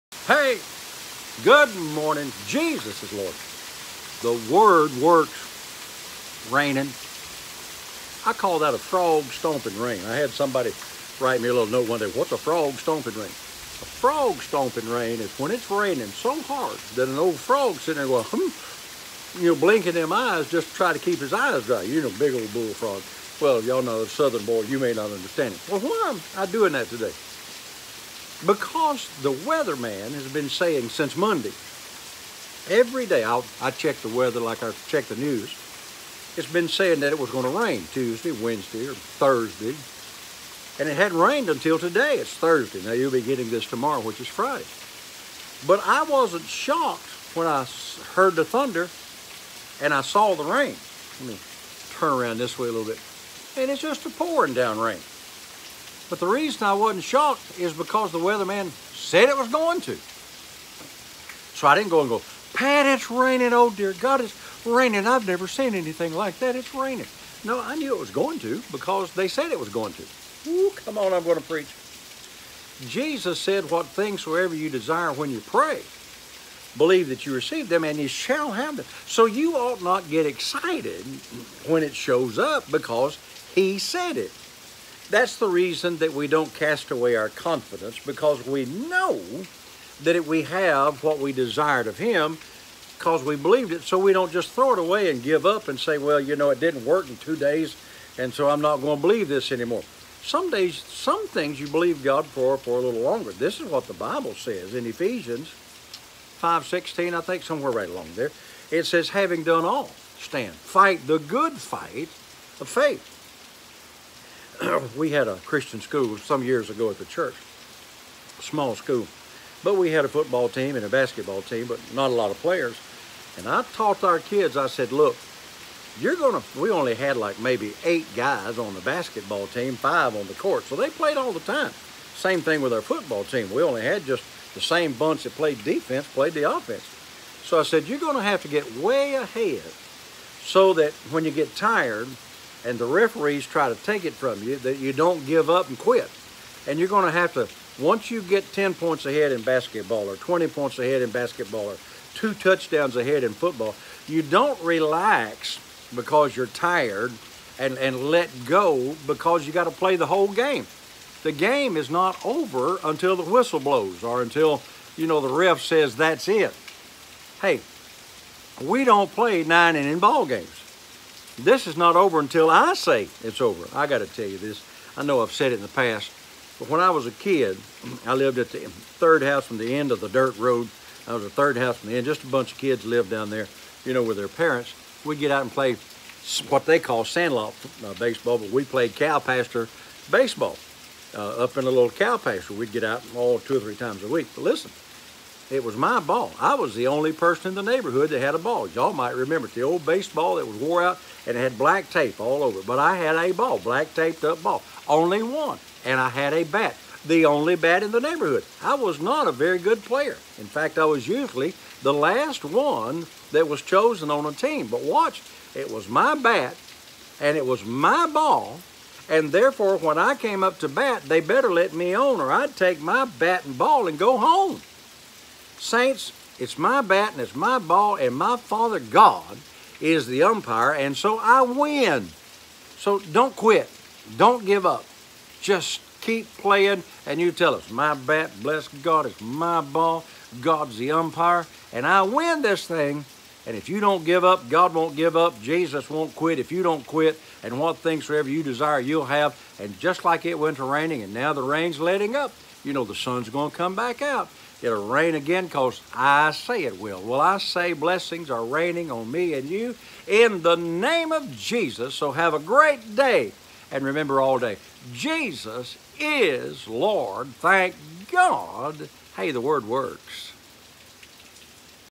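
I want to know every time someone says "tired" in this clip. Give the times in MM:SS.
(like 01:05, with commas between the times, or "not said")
02:21, 02:36.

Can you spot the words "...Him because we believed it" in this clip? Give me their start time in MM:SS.
01:31.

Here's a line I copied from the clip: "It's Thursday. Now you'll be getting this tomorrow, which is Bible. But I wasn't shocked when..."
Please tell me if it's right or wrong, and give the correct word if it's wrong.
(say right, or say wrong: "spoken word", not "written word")
wrong: "Friday", not "Bible".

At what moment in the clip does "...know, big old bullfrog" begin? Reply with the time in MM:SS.
00:22.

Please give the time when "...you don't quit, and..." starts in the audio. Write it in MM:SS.
04:06.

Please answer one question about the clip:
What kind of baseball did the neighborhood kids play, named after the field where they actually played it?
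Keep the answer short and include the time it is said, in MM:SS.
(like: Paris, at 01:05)
cow pasture baseball, at 03:08.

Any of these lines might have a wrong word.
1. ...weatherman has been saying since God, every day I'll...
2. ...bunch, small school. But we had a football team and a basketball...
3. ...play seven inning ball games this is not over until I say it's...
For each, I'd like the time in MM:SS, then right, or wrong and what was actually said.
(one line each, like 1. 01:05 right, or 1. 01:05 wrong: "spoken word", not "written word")
1. 00:29 wrong: "Monday", not "God"
2. 01:57 wrong: "church", not "bunch"
3. 02:49 wrong: "nine", not "seven".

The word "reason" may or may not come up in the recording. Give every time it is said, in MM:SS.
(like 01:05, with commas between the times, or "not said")
00:56, 01:25.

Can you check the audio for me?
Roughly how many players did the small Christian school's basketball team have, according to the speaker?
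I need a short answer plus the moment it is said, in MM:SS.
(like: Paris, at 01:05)
8, at 02:07.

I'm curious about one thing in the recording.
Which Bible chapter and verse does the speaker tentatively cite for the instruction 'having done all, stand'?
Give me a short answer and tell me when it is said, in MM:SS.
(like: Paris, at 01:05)
Ephesians 5:16, at 01:44.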